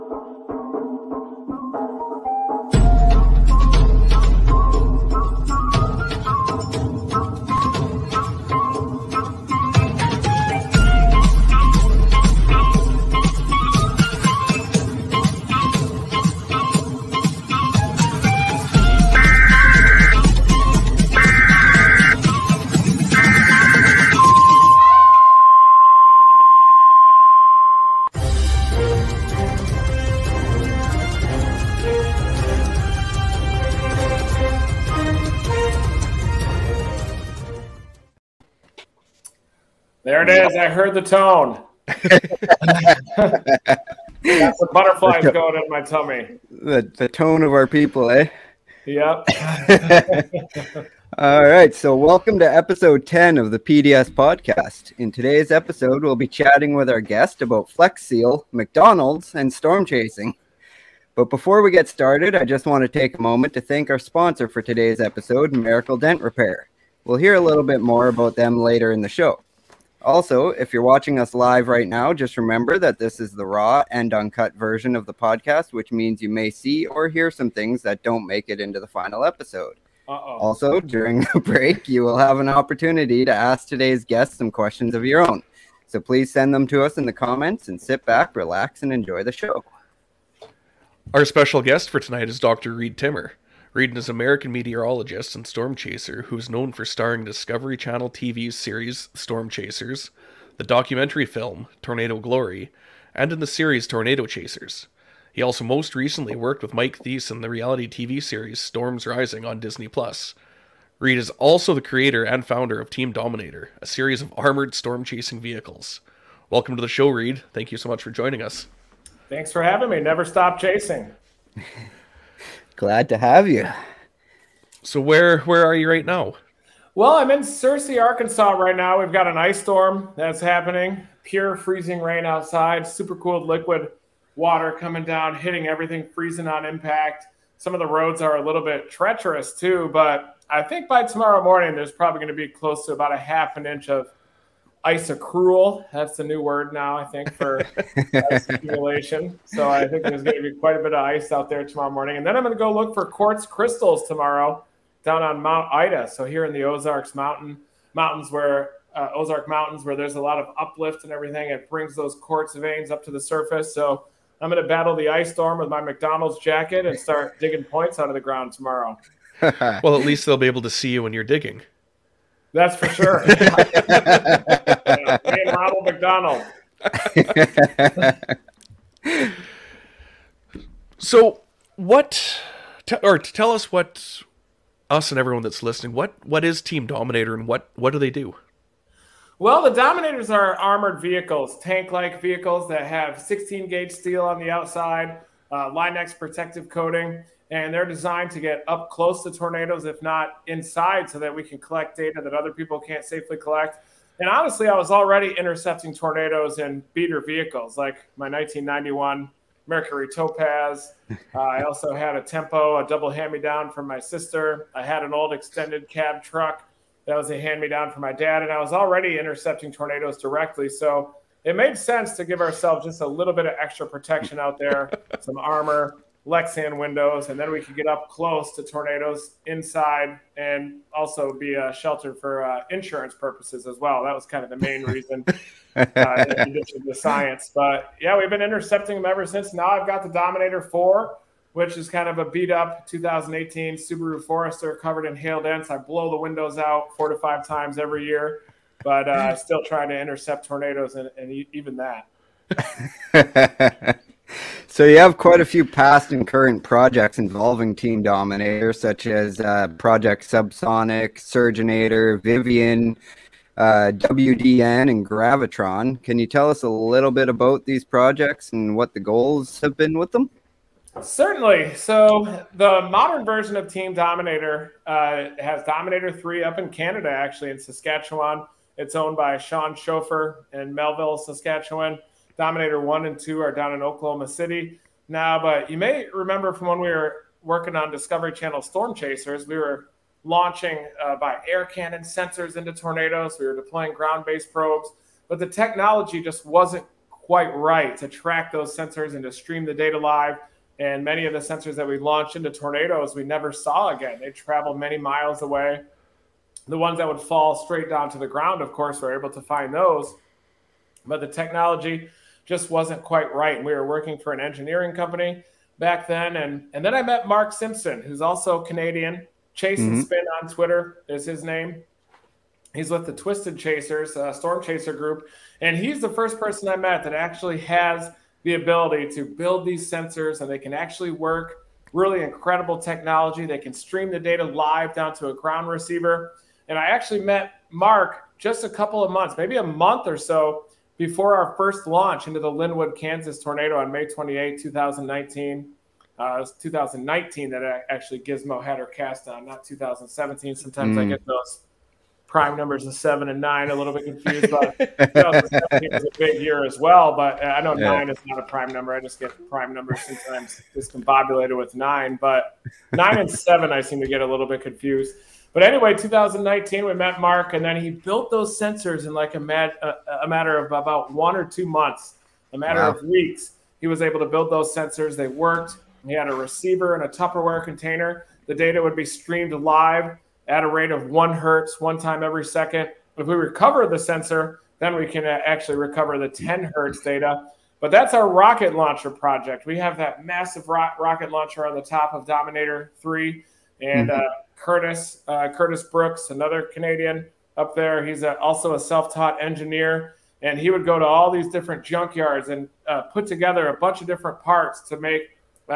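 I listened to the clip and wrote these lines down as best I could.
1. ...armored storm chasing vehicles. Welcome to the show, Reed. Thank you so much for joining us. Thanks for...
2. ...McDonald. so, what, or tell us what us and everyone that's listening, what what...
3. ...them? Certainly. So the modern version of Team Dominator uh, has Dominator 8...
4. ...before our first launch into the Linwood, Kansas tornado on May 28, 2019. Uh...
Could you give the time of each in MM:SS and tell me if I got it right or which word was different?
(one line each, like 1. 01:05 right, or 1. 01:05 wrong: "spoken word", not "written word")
1. 01:54 right
2. 02:55 right
3. 04:30 wrong: "3", not "8"
4. 05:40 right.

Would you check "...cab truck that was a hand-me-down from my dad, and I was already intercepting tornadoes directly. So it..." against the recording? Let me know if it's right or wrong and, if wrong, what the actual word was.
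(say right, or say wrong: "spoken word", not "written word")
right.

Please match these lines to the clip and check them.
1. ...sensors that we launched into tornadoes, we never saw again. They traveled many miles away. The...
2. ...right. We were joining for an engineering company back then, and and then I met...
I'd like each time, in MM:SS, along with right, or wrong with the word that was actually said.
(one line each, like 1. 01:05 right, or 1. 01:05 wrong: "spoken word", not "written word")
1. 05:01 right
2. 05:13 wrong: "working", not "joining".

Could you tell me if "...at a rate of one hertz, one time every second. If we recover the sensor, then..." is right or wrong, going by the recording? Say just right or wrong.
right.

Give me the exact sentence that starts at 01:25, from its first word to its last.
So please send them to us in the comments and sit back, relax, and enjoy the show.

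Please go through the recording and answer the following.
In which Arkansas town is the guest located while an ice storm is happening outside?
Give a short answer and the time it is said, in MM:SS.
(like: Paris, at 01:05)
Searcy, at 02:07.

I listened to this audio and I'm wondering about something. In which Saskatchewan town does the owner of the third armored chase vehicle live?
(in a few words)
Melville.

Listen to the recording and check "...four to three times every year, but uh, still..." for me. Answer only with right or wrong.
wrong.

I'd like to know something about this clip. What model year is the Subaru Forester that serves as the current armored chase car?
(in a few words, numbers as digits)
2018.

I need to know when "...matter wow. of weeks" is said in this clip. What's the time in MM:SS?
06:12.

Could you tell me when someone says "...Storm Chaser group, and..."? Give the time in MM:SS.
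05:24.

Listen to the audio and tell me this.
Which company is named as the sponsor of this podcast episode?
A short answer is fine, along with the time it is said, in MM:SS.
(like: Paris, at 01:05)
Miracle Dent Repair, at 01:05.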